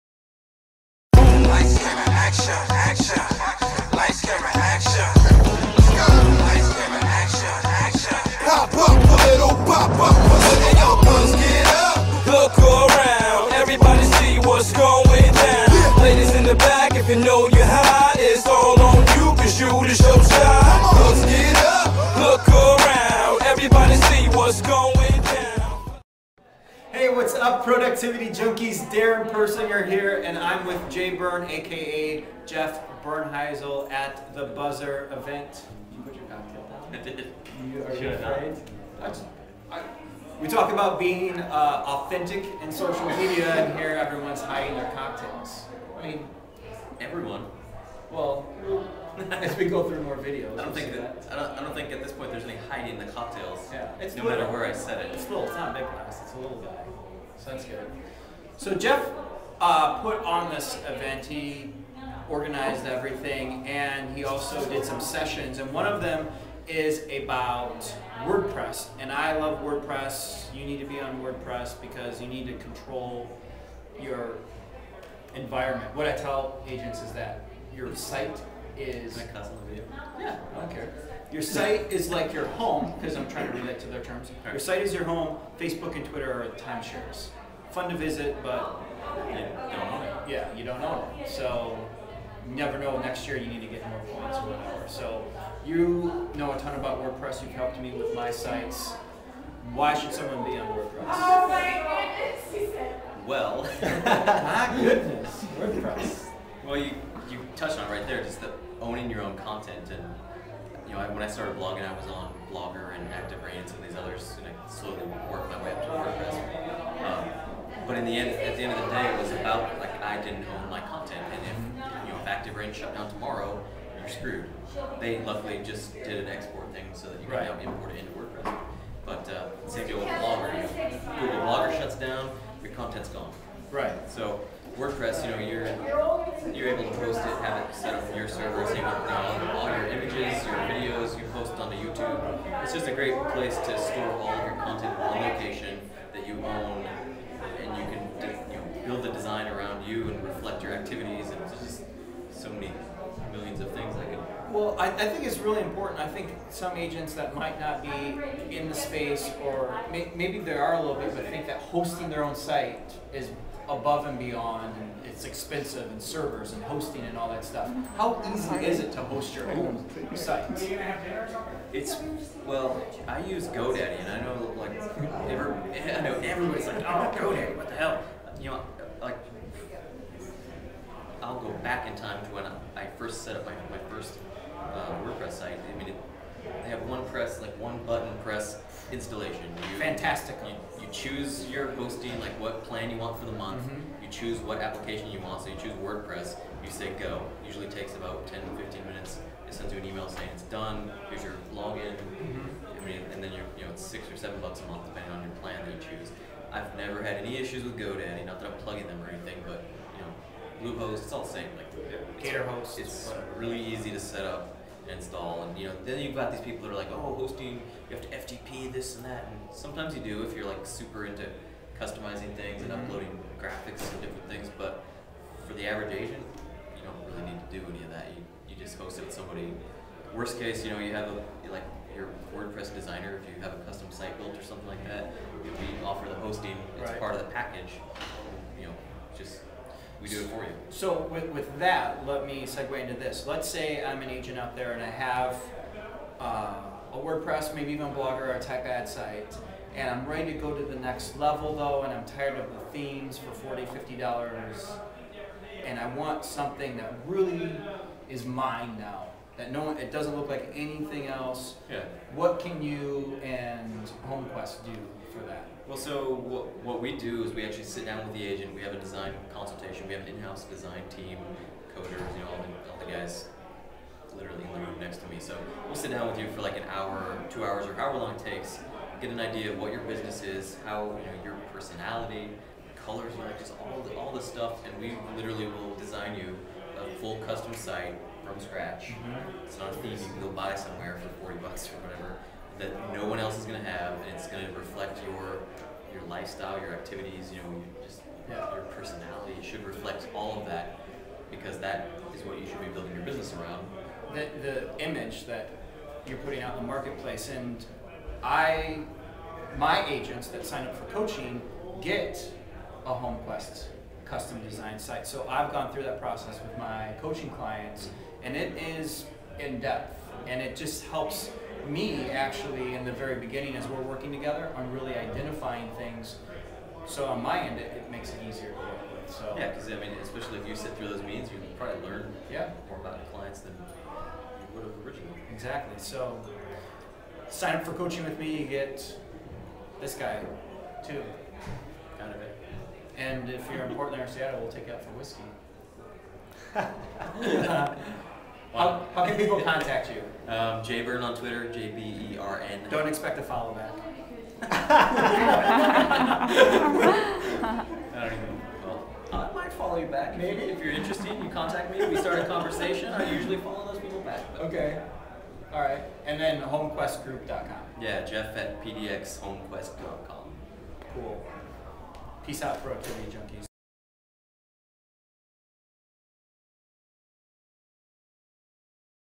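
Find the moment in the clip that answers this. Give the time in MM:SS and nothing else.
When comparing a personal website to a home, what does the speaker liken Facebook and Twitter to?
01:26.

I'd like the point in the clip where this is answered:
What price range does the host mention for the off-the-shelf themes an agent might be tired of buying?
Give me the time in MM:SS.
04:13.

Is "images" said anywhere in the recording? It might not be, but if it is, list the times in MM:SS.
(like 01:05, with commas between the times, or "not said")
02:19, 05:04.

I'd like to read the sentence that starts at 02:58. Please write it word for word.
You know, like I'll go back in time to when I first set up my, my first uh, WordPress site.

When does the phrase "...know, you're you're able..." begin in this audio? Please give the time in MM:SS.
02:15.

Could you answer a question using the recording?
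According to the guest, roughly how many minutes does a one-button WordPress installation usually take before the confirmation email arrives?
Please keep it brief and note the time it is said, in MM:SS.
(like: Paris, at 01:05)
10-15 minutes, at 03:18.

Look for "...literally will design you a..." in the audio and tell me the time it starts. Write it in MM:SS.
04:45.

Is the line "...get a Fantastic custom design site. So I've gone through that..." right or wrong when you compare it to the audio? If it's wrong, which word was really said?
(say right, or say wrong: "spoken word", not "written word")
wrong: "HomeQuest", not "Fantastic".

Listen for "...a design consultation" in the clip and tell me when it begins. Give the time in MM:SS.
04:28.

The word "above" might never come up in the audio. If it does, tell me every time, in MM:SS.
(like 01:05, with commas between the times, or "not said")
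02:43.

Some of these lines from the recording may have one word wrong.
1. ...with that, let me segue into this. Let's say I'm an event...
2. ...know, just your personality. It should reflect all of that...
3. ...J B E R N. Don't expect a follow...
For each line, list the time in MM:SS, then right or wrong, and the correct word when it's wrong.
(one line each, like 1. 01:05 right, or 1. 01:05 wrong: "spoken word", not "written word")
1. 04:01 wrong: "agent", not "event"
2. 04:57 right
3. 05:51 right.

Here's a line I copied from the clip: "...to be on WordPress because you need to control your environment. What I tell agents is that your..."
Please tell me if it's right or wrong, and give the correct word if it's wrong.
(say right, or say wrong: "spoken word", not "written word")
right.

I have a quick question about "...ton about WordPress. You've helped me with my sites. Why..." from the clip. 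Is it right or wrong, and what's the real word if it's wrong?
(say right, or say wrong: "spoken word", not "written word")
right.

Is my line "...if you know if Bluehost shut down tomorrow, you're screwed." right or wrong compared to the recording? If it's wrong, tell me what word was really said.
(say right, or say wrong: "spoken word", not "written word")
wrong: "ActiveRain", not "Bluehost".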